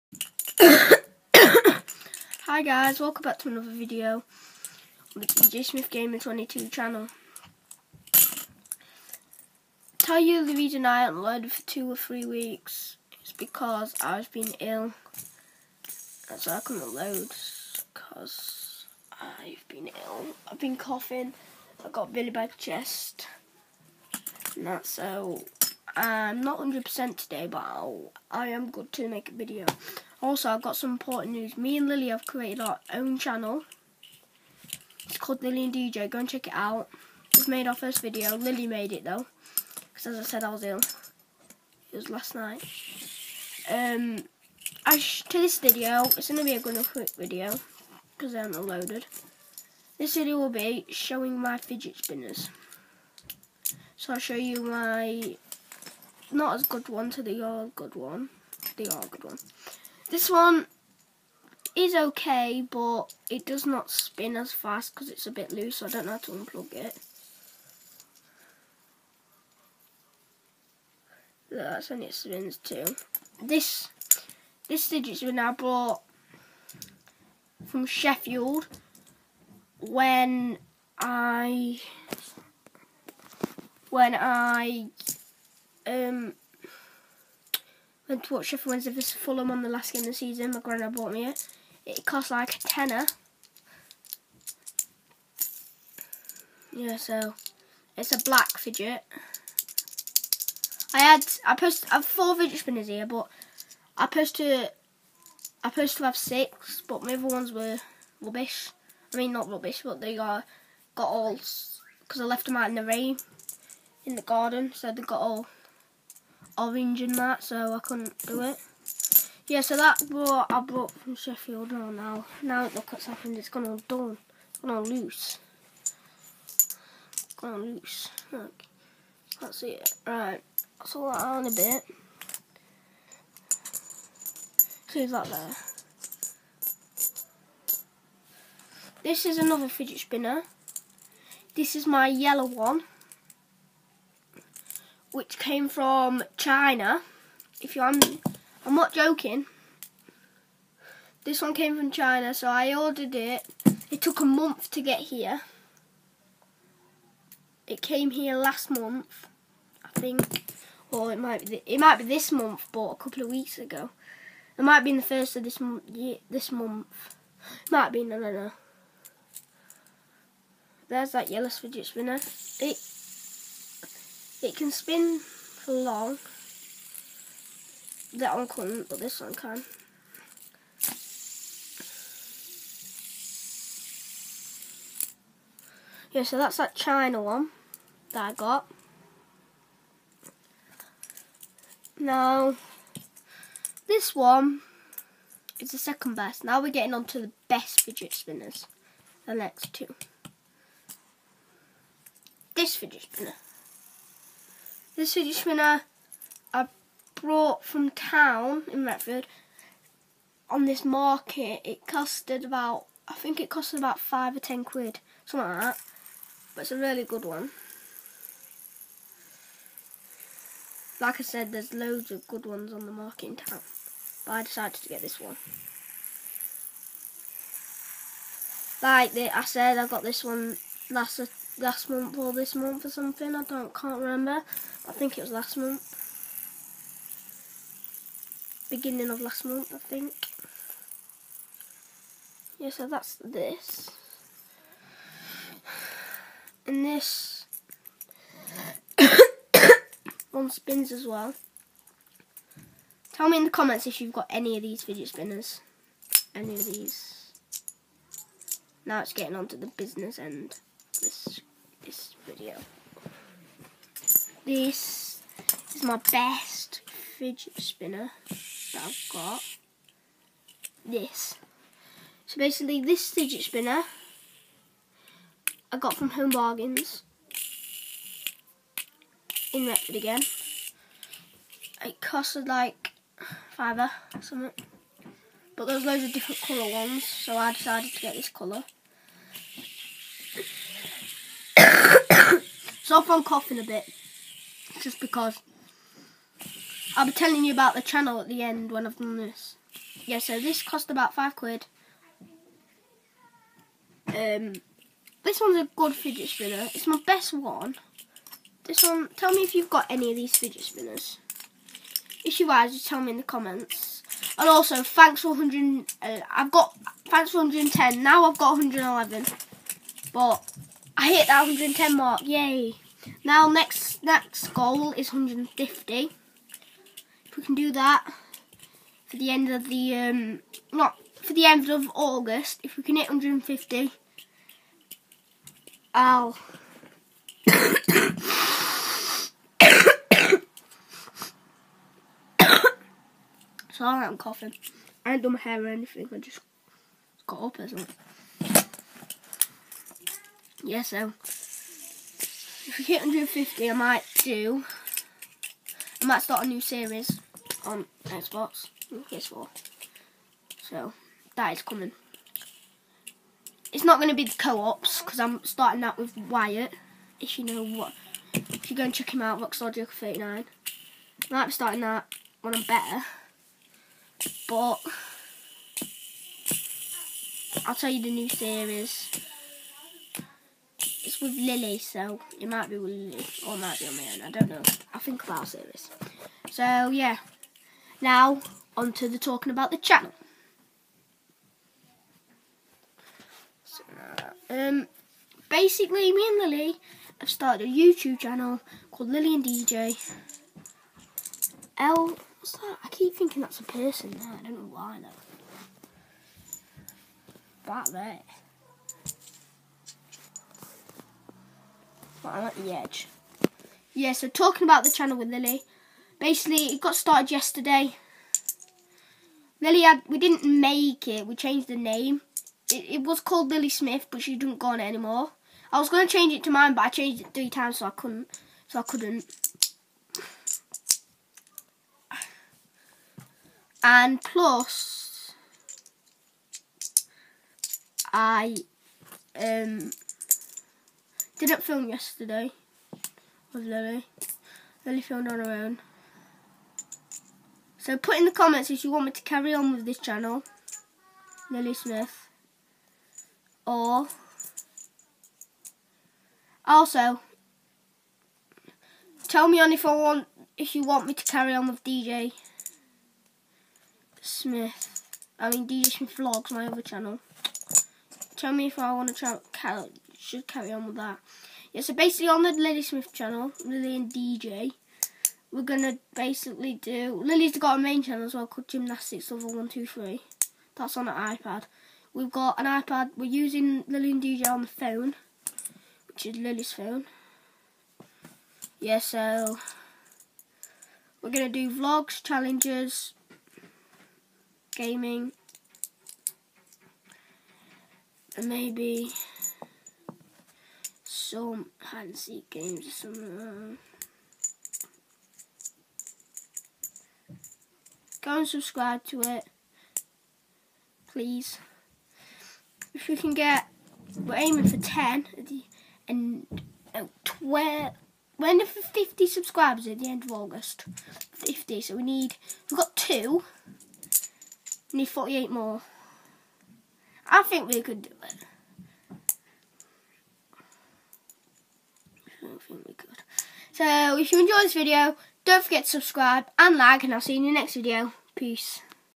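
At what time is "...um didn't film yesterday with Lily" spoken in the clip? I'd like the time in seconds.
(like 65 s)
439 s.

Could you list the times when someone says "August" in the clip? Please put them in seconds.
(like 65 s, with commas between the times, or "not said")
331 s, 520 s.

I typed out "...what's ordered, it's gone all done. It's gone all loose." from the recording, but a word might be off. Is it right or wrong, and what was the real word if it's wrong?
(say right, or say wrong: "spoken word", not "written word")
wrong: "happened", not "ordered".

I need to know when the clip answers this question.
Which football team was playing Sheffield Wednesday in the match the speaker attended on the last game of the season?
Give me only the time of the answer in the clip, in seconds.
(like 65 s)
89 s.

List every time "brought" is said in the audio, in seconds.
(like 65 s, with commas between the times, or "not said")
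120 s, 207 s.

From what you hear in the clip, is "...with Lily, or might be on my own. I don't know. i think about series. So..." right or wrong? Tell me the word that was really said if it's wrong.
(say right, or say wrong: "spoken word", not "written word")
right.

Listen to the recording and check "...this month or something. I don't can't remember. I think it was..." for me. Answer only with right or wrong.
right.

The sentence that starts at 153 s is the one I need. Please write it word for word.
It took a month to get here.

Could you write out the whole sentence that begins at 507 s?
Uh, go and subscribe to it, please.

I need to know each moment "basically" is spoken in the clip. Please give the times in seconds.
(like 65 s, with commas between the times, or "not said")
272 s, 395 s, 416 s, 471 s, 476 s.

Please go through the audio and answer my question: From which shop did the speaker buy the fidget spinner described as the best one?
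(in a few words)
Home Bargains.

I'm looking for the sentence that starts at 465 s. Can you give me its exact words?
I mean DJ Smith Vlogs, my other channel.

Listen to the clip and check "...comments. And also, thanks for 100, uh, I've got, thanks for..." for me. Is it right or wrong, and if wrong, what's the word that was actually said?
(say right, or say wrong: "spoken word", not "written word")
right.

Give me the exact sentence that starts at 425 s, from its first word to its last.
I was going to change it to mine, but I changed it three times, so I couldn't.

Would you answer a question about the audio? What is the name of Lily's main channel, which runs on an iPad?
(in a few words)
Gymnastics Level One Two Three.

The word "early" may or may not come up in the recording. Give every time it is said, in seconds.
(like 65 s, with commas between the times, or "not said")
not said.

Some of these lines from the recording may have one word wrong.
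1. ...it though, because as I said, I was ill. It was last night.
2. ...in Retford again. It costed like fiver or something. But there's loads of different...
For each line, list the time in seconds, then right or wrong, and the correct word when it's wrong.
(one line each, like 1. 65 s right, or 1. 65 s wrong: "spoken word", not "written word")
1. 38 s right
2. 279 s right.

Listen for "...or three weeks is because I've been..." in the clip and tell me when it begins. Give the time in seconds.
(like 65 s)
11 s.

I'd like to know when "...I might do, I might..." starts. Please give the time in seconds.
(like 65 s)
353 s.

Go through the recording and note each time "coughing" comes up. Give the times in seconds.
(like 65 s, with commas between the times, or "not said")
20 s, 293 s, 344 s.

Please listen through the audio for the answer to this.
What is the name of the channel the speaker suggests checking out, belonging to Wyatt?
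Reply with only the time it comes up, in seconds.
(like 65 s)
369 s.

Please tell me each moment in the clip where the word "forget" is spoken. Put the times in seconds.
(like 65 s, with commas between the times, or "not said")
535 s.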